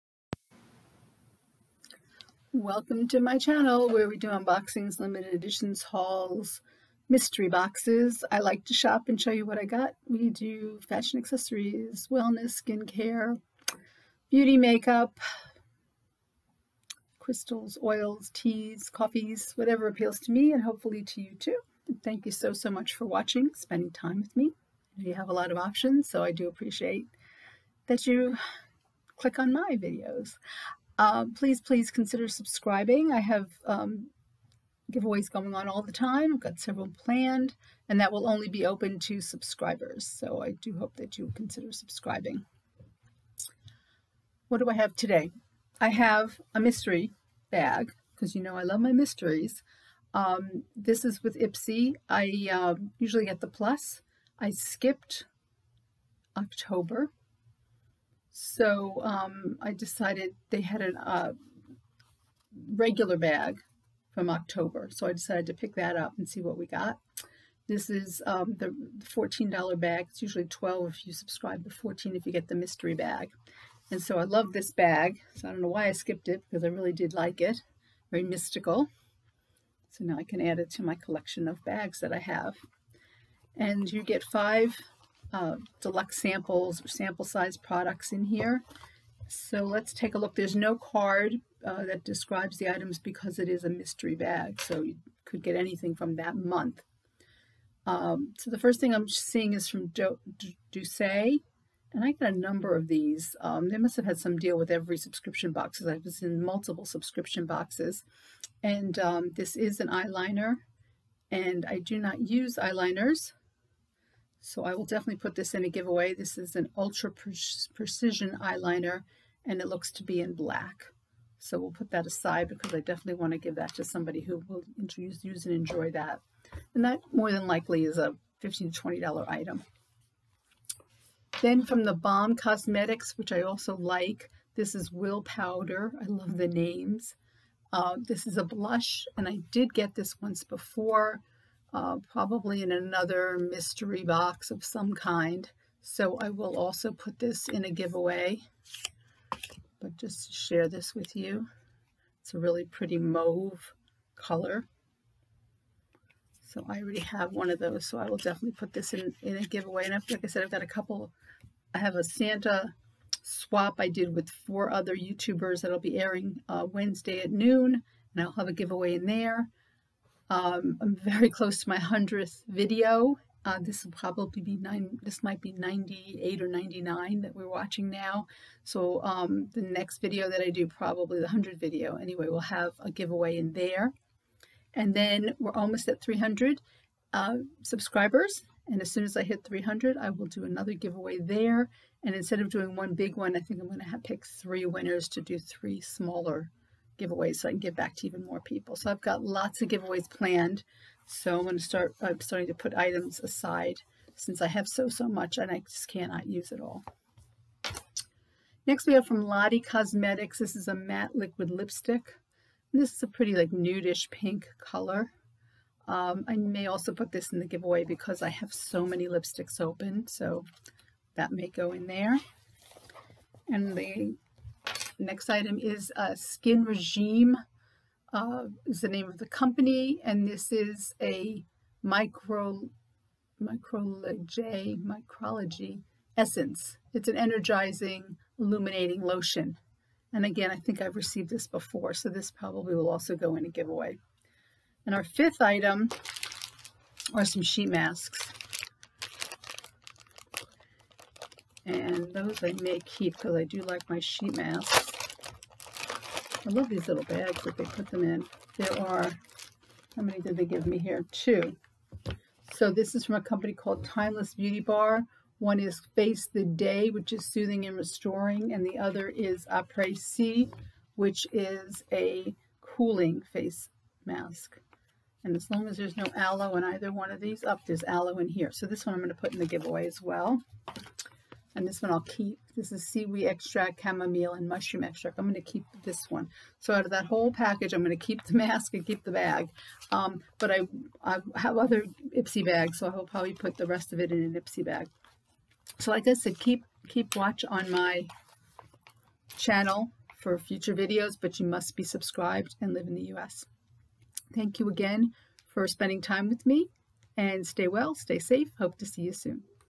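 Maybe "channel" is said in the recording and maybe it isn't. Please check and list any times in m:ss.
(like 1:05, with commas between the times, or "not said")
0:03, 4:59.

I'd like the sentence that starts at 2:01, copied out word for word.
So we'll put that aside because I definitely want to give that to somebody who will use, use and enjoy that.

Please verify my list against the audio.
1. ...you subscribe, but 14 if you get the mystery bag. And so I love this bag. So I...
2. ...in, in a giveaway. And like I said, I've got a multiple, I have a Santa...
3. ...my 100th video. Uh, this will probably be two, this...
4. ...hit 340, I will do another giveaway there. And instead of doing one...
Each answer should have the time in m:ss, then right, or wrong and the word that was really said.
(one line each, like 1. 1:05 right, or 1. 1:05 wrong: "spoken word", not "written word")
1. 1:11 right
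2. 2:38 wrong: "couple", not "multiple"
3. 2:51 wrong: "nine", not "two"
4. 3:09 wrong: "300", not "340".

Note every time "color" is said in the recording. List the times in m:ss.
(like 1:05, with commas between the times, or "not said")
2:34, 3:34.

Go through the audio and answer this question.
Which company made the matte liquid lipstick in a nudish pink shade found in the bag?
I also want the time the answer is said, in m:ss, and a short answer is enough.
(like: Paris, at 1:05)
Lottie Cosmetics, at 3:29.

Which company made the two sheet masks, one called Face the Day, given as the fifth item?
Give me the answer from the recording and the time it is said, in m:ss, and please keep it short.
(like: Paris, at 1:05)
Timeless Beauty Bar, at 4:23.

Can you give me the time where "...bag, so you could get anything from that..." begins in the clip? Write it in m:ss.
1:34.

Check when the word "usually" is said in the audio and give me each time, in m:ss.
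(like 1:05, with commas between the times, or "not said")
0:52, 1:10.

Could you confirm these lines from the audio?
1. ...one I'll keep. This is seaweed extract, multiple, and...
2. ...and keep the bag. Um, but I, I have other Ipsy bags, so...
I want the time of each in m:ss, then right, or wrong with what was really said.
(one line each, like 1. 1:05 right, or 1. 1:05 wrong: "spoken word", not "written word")
1. 4:41 wrong: "chamomile", not "multiple"
2. 4:48 right.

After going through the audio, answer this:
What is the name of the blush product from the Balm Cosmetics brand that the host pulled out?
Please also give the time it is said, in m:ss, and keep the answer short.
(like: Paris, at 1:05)
Will Powder, at 2:14.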